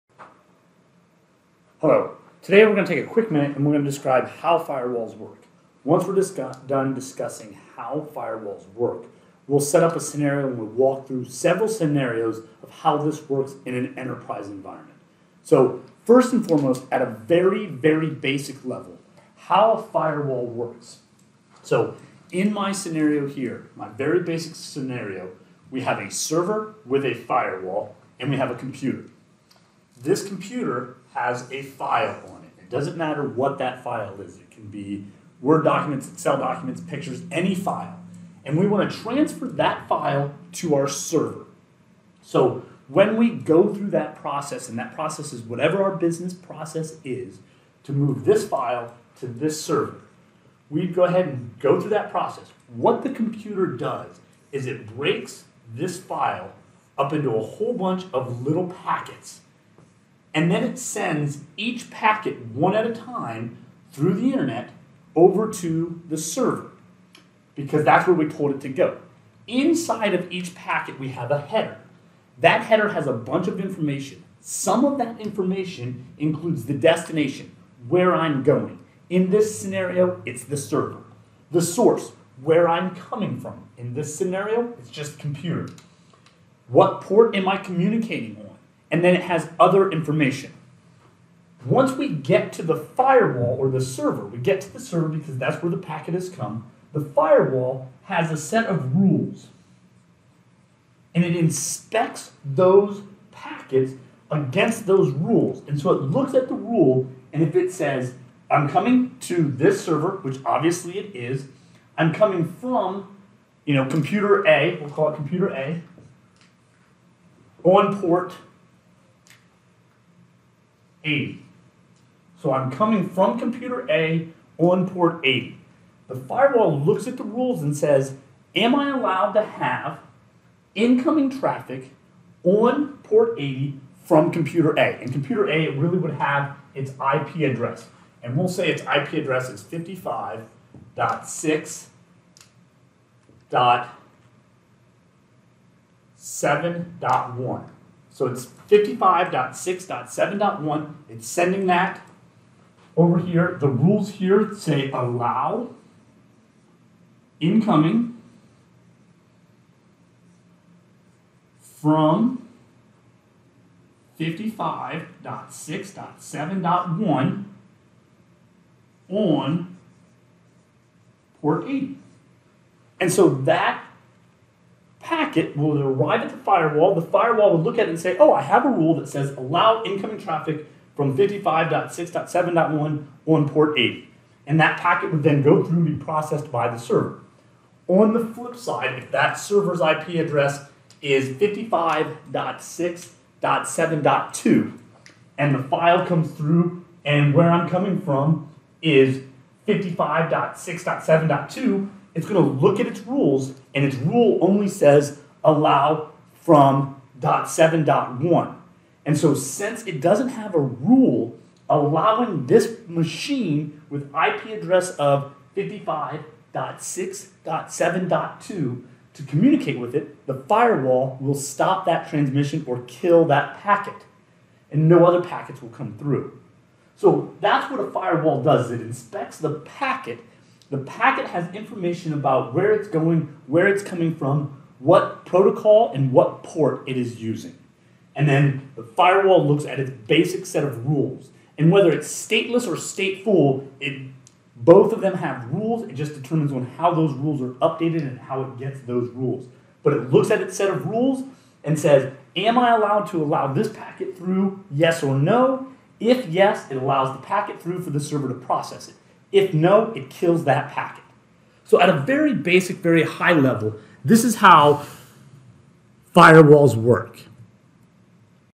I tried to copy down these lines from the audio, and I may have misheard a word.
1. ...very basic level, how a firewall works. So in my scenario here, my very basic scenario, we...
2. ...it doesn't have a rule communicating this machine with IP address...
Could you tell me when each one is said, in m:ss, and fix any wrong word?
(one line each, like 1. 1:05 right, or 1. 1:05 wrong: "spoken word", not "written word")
1. 0:17 right
2. 3:29 wrong: "allowing", not "communicating".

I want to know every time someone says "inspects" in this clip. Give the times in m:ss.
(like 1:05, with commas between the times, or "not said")
1:41, 3:48.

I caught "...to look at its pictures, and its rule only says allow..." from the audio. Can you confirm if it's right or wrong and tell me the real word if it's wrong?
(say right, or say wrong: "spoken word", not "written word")
wrong: "rules", not "pictures".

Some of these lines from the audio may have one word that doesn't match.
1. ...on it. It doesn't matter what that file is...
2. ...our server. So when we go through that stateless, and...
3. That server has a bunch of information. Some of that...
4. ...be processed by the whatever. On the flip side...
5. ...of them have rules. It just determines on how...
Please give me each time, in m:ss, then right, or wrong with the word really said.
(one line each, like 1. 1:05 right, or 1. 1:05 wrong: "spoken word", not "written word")
1. 0:32 right
2. 0:40 wrong: "process", not "stateless"
3. 1:12 wrong: "header", not "server"
4. 3:05 wrong: "server", not "whatever"
5. 4:04 right.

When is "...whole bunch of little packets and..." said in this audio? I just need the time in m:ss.
0:57.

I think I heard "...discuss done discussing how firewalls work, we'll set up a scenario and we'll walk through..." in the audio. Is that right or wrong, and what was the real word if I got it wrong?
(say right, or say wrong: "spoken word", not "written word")
right.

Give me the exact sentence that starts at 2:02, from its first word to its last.
So I'm coming from computer A on port 80.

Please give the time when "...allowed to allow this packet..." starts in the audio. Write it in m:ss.
4:12.